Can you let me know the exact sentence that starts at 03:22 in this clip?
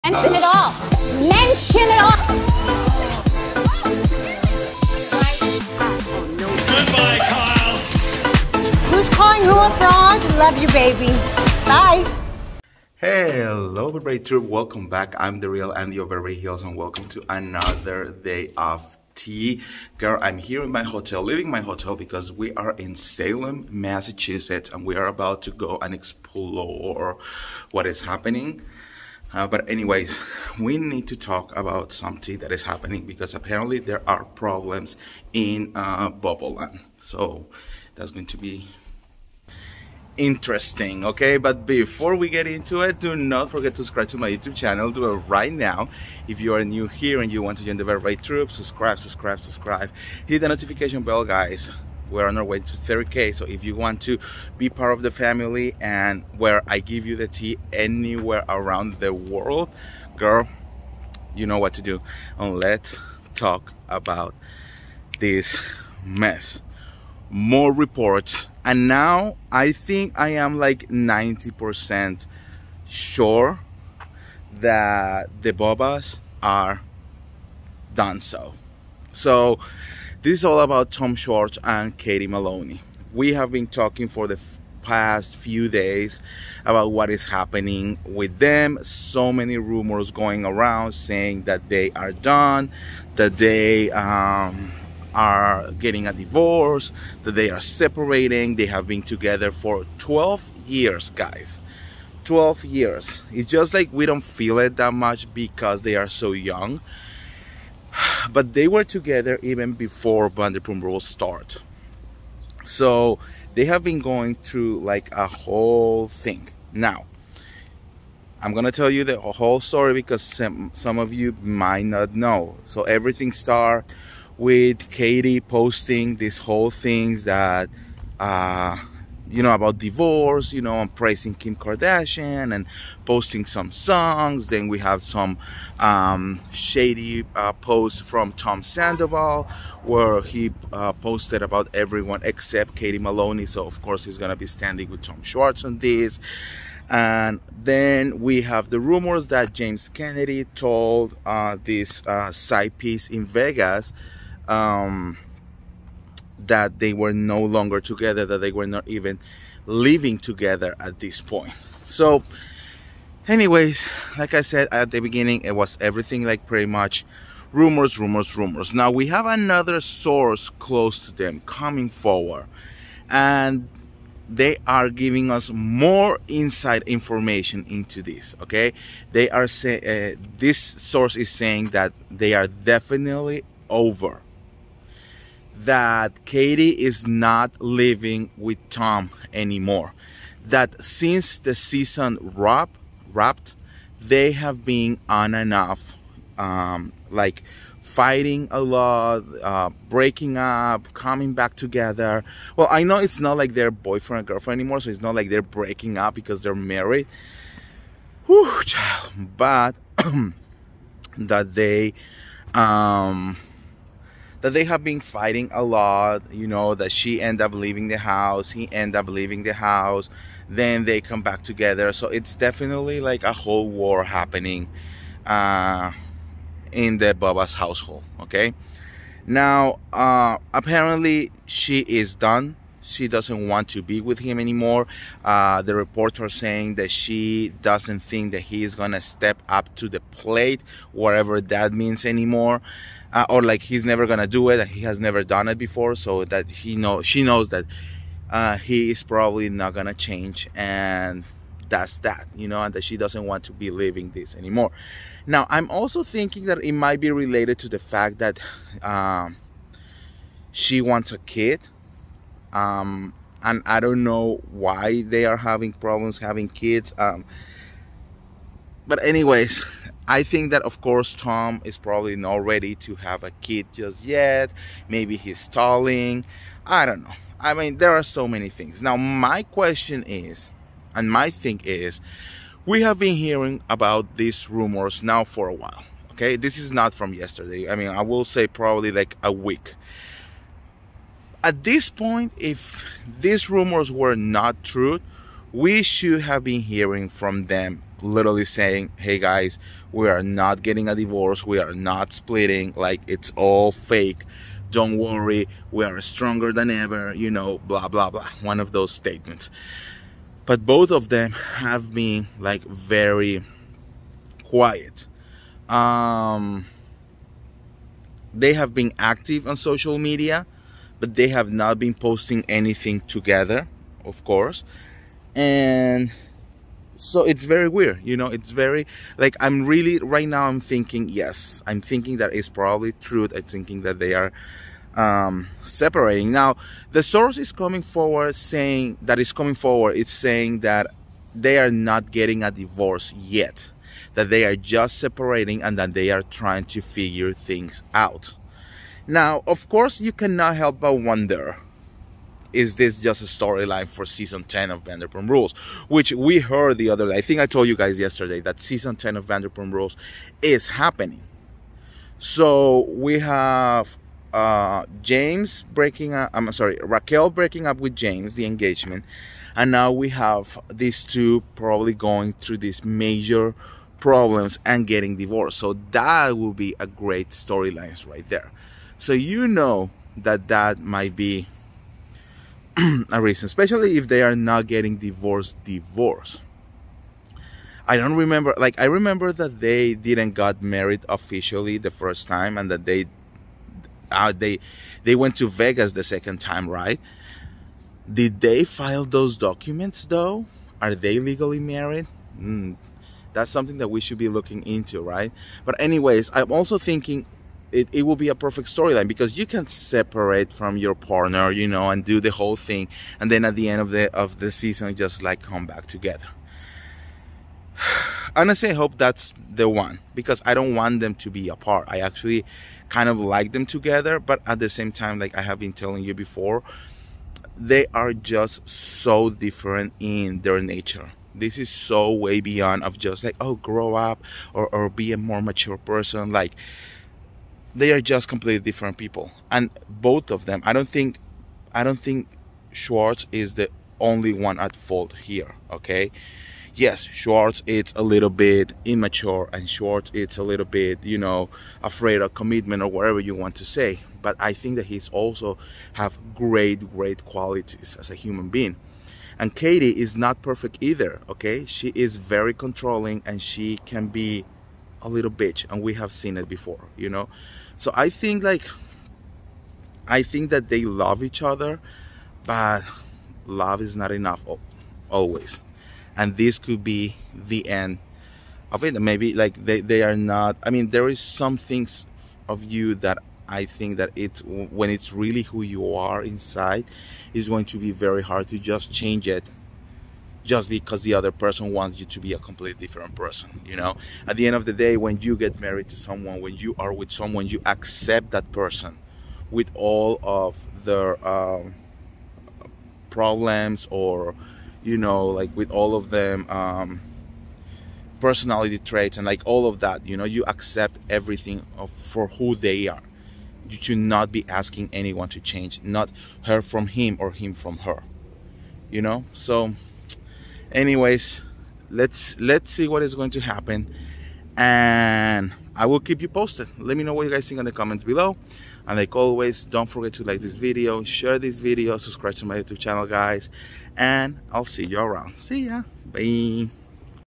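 Well, I know it's not like they're boyfriend and girlfriend anymore, so it's not like they're breaking up because they're married.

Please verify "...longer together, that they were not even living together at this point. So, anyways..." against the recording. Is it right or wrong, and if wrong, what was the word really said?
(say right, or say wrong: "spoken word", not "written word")
right.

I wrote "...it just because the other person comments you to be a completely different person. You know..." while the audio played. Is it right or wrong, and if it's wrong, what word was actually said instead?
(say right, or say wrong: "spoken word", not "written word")
wrong: "wants", not "comments".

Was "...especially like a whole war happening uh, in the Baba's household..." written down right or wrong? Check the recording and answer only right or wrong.
wrong.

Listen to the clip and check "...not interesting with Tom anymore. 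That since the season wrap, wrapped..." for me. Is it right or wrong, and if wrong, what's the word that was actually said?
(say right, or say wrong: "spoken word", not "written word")
wrong: "living", not "interesting".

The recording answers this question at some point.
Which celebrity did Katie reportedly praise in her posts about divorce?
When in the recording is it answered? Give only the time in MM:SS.
02:11.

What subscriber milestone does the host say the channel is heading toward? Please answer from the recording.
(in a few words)
30k.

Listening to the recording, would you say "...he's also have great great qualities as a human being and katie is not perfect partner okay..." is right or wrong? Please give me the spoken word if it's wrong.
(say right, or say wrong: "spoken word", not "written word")
wrong: "either", not "partner".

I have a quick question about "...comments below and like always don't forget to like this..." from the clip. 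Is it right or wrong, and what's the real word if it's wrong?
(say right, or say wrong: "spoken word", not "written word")
right.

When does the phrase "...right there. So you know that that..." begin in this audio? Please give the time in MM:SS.
06:18.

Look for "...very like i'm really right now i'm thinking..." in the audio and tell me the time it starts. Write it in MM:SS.
05:28.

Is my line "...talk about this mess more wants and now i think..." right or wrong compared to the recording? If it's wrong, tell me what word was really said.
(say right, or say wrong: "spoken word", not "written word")
wrong: "reports", not "wants".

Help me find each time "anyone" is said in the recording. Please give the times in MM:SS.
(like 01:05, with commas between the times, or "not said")
08:34.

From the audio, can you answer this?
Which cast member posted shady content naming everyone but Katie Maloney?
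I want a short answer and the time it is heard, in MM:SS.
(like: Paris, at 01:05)
Tom Sandoval, at 02:18.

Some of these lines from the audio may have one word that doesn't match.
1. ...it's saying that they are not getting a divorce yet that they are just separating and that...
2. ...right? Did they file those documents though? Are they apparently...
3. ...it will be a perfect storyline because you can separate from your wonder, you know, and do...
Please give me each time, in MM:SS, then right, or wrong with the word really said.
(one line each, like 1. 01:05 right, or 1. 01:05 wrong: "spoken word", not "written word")
1. 05:39 right
2. 06:36 wrong: "legally", not "apparently"
3. 06:47 wrong: "partner", not "wonder".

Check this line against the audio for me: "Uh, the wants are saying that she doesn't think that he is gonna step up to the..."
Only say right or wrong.
wrong.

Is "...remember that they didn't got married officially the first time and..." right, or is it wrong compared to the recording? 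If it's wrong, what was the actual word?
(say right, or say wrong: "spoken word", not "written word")
right.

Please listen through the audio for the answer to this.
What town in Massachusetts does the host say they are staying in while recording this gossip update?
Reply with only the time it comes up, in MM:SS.
00:22.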